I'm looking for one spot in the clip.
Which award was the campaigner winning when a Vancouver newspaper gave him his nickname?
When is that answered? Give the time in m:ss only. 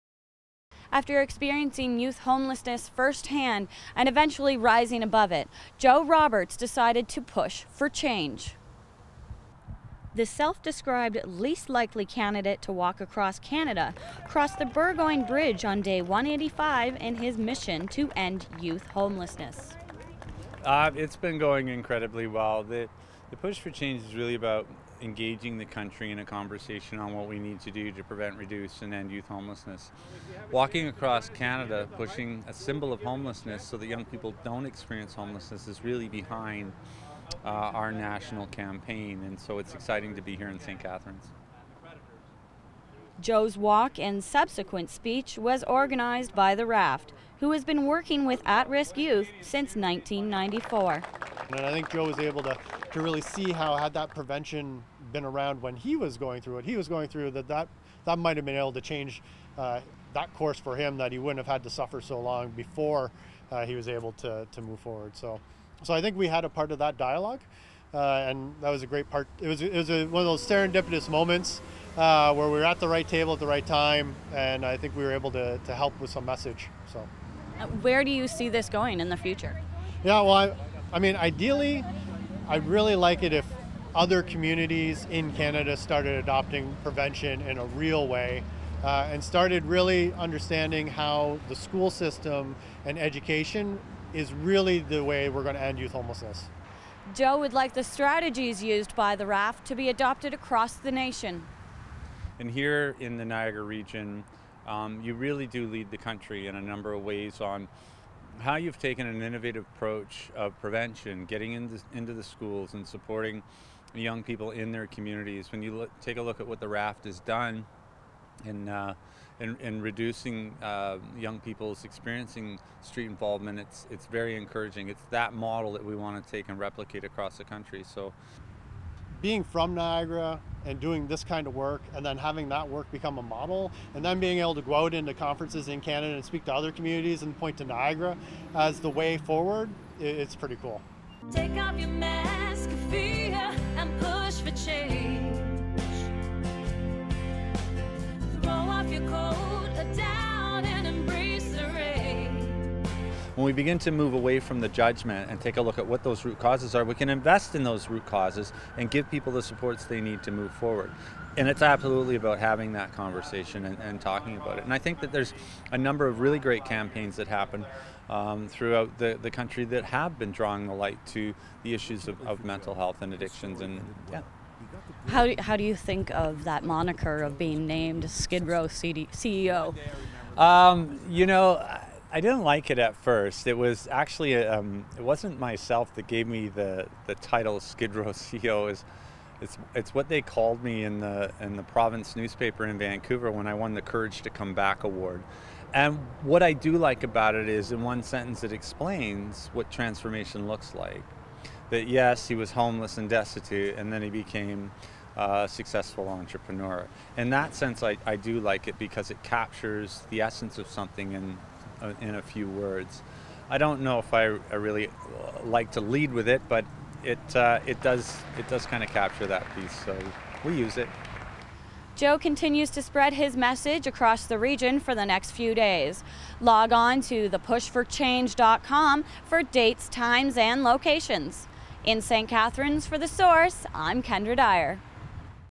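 3:13.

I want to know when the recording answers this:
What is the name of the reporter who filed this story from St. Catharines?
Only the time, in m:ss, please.
3:54.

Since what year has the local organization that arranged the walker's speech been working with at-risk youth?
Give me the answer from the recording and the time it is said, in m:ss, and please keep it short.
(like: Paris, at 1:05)
1994, at 0:49.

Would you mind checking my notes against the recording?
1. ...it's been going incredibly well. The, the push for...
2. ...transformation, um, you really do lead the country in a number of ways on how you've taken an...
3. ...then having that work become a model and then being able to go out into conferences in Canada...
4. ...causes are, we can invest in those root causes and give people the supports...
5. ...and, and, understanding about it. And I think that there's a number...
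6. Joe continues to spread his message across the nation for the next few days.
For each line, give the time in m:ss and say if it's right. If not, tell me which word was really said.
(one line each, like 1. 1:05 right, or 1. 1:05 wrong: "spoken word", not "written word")
1. 0:20 right
2. 1:43 wrong: "region", not "transformation"
3. 2:12 right
4. 2:36 right
5. 2:43 wrong: "talking", not "understanding"
6. 3:41 wrong: "region", not "nation".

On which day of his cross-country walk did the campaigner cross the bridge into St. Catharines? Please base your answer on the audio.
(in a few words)
185.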